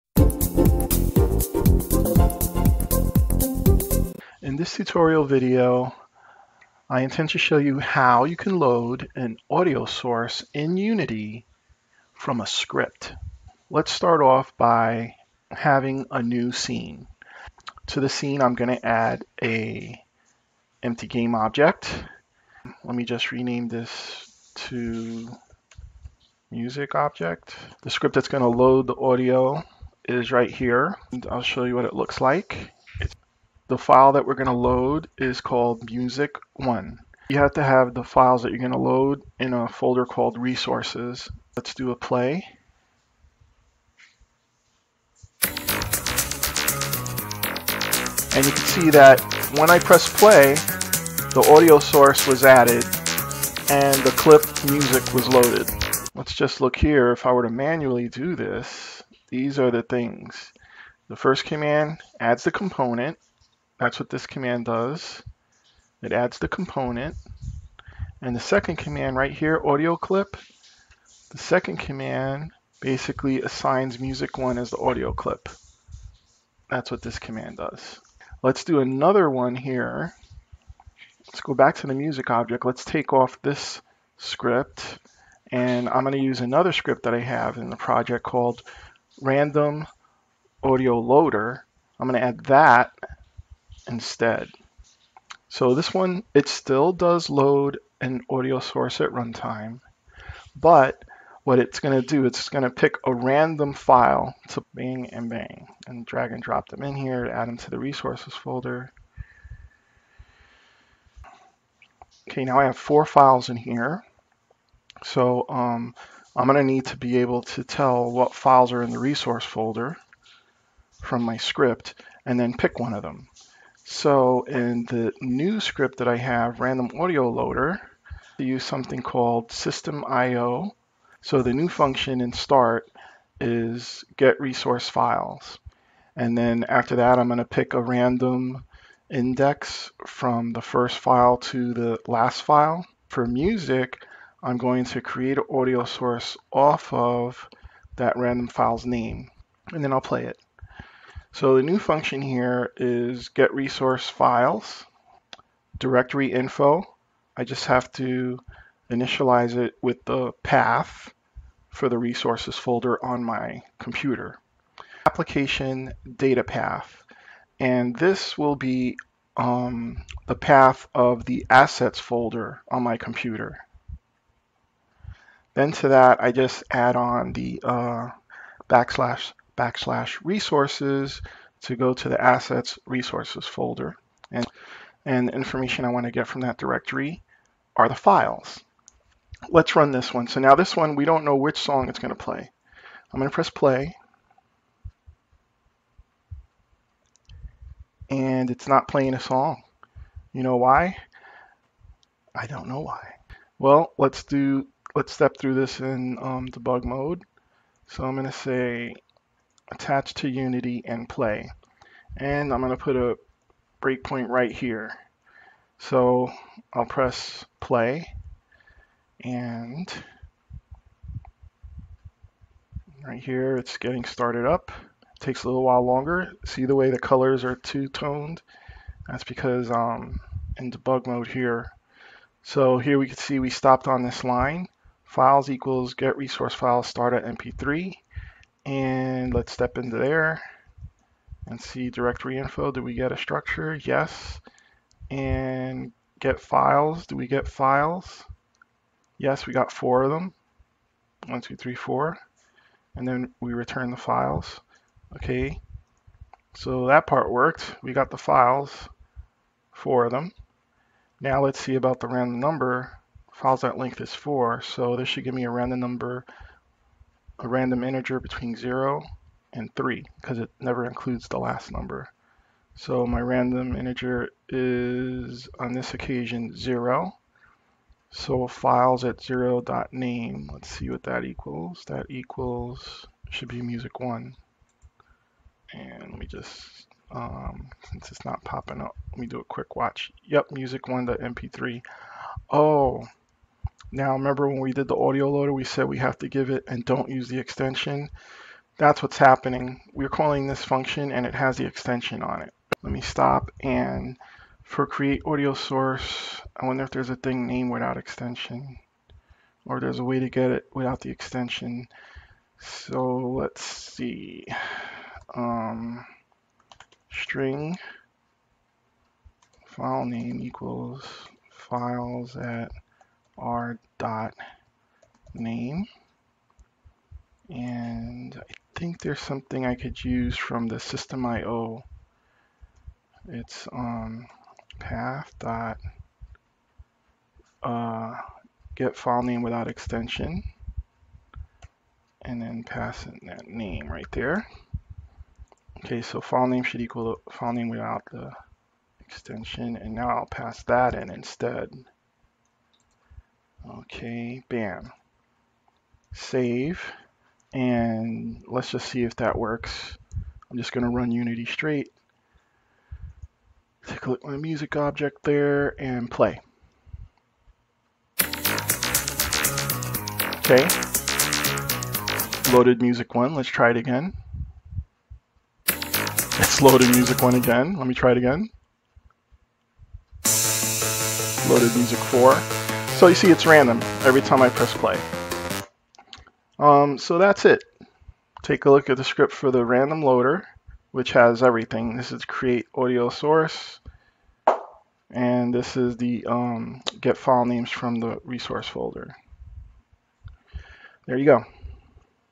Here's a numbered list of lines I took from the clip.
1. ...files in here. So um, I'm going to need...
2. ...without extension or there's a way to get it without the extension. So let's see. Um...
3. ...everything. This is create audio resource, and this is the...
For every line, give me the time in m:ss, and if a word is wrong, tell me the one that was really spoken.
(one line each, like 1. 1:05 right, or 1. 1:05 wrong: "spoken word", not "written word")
1. 1:53 right
2. 5:07 right
3. 6:31 wrong: "source", not "resource".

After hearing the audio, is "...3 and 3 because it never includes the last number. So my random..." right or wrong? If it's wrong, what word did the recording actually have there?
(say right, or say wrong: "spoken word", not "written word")
wrong: "0", not "3".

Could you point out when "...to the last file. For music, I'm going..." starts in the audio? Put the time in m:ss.
2:21.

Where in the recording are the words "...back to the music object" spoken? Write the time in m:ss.
1:21.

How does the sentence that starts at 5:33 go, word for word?
It's um, path dot uh, get file name without extension and then pass in that name right there.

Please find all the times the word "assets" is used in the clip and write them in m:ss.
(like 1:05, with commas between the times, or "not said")
2:51, 3:02.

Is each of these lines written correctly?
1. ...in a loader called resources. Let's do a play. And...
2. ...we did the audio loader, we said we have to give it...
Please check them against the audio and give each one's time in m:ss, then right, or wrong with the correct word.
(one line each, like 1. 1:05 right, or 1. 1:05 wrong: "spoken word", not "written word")
1. 0:39 wrong: "folder", not "loader"
2. 4:54 right.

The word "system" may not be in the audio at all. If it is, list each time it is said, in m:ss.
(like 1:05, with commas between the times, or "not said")
2:09, 5:30.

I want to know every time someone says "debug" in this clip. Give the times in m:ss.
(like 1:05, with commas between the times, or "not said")
3:26, 3:50.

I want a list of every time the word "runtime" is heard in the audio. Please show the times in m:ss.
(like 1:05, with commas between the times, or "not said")
1:39.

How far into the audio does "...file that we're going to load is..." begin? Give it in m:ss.
0:33.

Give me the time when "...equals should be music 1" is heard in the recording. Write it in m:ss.
4:42.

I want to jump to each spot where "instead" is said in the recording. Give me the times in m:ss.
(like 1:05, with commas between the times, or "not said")
1:33, 5:51.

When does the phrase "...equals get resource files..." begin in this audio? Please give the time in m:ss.
3:55.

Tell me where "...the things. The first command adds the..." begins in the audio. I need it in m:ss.
0:59.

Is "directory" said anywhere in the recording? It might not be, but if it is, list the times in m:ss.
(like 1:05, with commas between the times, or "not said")
2:35, 3:06, 4:01.